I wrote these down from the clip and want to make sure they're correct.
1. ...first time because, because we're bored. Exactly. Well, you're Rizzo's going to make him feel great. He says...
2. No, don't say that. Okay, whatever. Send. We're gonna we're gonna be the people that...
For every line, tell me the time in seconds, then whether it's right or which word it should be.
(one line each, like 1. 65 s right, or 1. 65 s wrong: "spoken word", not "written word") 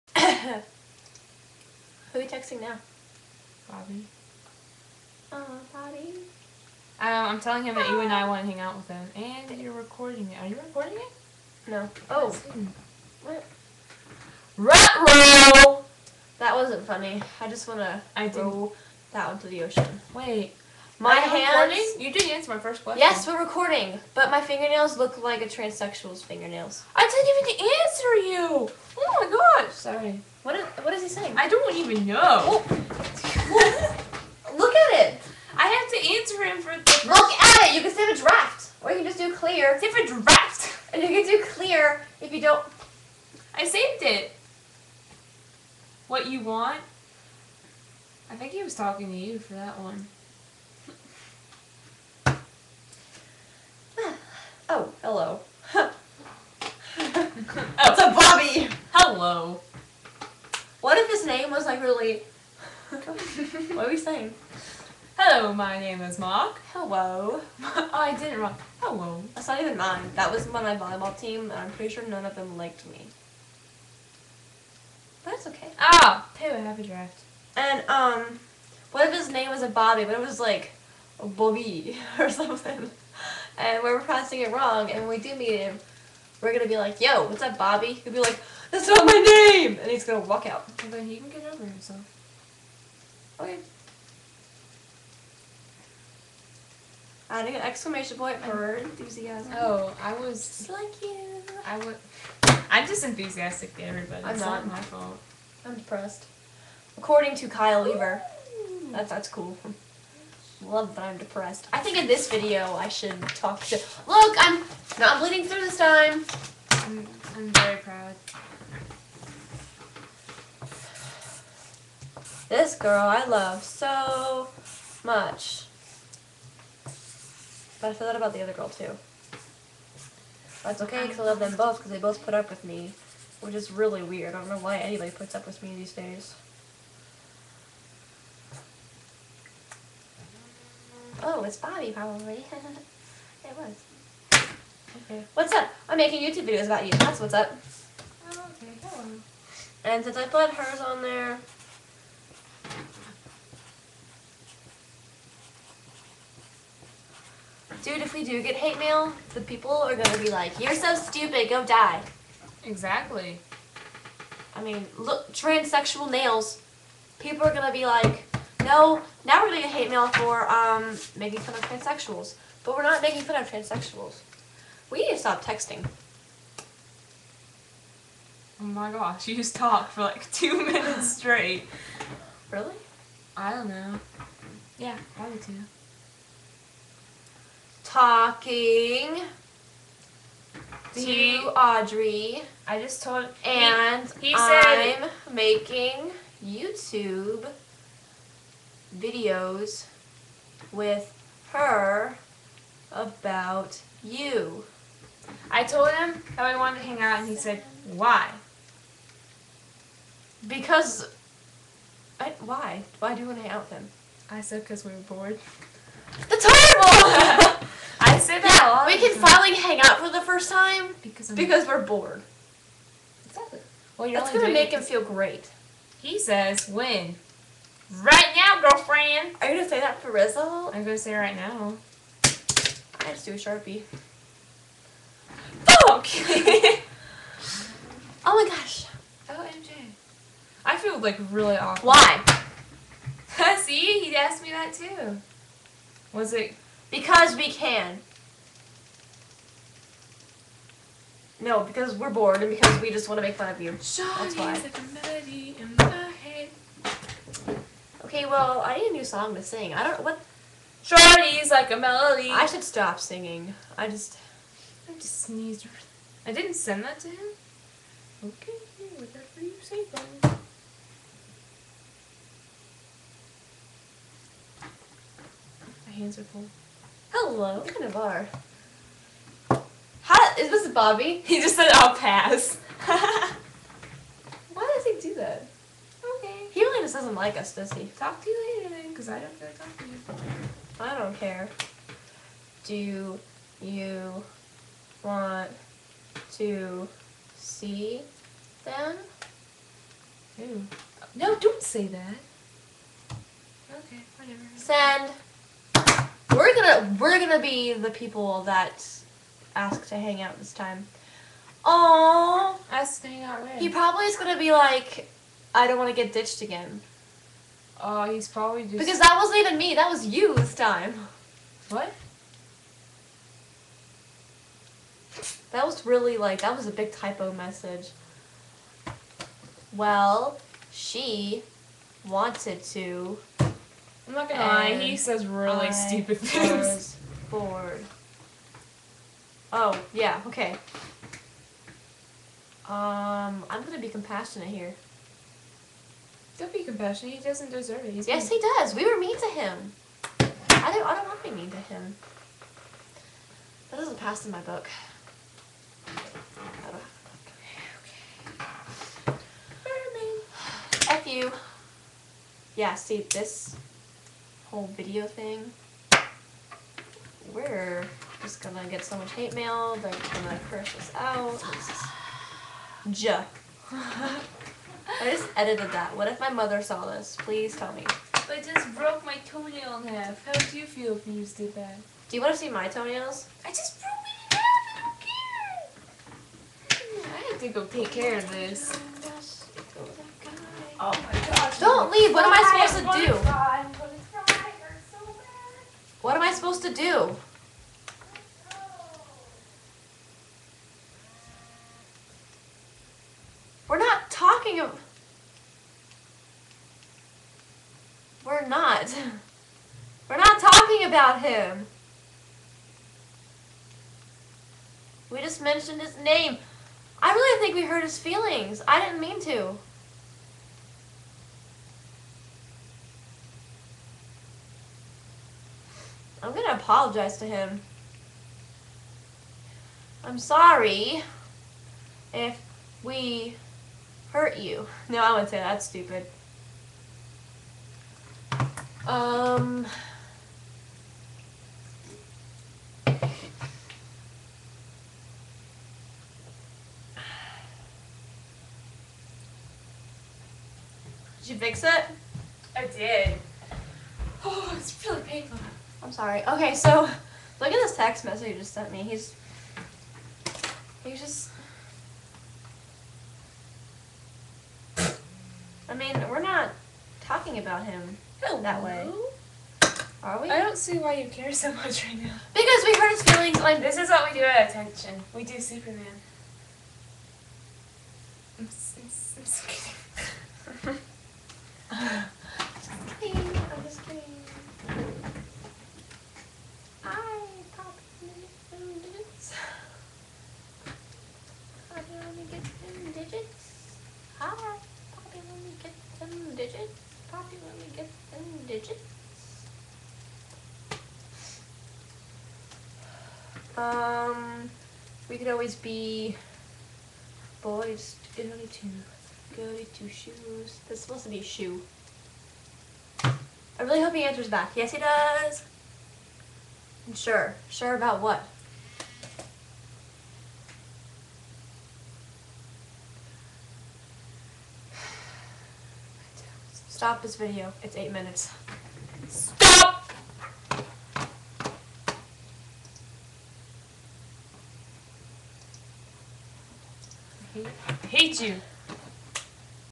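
1. 220 s wrong: "That", not "Rizzo"
2. 301 s right.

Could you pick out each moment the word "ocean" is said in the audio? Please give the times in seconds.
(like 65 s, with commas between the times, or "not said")
19 s.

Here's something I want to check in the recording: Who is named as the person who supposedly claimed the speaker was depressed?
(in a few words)
Kyle Lever.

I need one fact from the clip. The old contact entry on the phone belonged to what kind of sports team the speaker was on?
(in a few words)
volleyball team.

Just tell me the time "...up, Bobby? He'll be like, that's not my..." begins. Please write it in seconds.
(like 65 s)
87 s.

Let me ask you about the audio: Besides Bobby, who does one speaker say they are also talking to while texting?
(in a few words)
Audrey.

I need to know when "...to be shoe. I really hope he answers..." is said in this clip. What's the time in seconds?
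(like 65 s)
511 s.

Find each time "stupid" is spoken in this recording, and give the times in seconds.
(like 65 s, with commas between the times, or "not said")
160 s, 335 s, 435 s.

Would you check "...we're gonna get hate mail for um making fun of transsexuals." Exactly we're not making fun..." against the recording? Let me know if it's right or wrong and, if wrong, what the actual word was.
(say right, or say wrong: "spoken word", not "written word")
wrong: "But", not "Exactly".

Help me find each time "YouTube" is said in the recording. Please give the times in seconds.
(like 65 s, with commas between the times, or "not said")
146 s, 196 s.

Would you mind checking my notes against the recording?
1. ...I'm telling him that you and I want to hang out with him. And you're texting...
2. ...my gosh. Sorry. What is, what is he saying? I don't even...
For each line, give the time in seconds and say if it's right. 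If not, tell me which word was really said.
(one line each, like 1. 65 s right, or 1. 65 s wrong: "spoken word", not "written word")
1. 6 s wrong: "recording", not "texting"
2. 29 s right.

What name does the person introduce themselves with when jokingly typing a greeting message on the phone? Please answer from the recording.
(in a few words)
Mark.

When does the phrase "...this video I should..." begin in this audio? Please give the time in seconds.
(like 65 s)
112 s.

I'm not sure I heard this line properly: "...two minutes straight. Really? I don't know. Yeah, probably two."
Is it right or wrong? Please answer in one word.
right.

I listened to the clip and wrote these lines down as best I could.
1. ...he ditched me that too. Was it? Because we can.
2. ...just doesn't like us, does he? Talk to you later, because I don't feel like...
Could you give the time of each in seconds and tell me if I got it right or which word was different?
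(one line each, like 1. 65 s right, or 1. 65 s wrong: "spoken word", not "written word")
1. 243 s wrong: "asked", not "ditched"
2. 286 s right.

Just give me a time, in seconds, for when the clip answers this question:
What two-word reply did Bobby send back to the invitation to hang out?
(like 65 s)
281 s.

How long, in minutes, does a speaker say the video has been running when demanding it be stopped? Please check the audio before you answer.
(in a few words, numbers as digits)
8.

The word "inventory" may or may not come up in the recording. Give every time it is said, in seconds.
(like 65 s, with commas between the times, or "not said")
not said.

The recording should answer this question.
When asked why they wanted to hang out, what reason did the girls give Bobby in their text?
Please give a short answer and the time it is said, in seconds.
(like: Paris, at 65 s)
Because we were bored, at 214 s.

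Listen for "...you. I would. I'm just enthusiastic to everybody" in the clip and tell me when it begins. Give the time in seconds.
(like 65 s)
101 s.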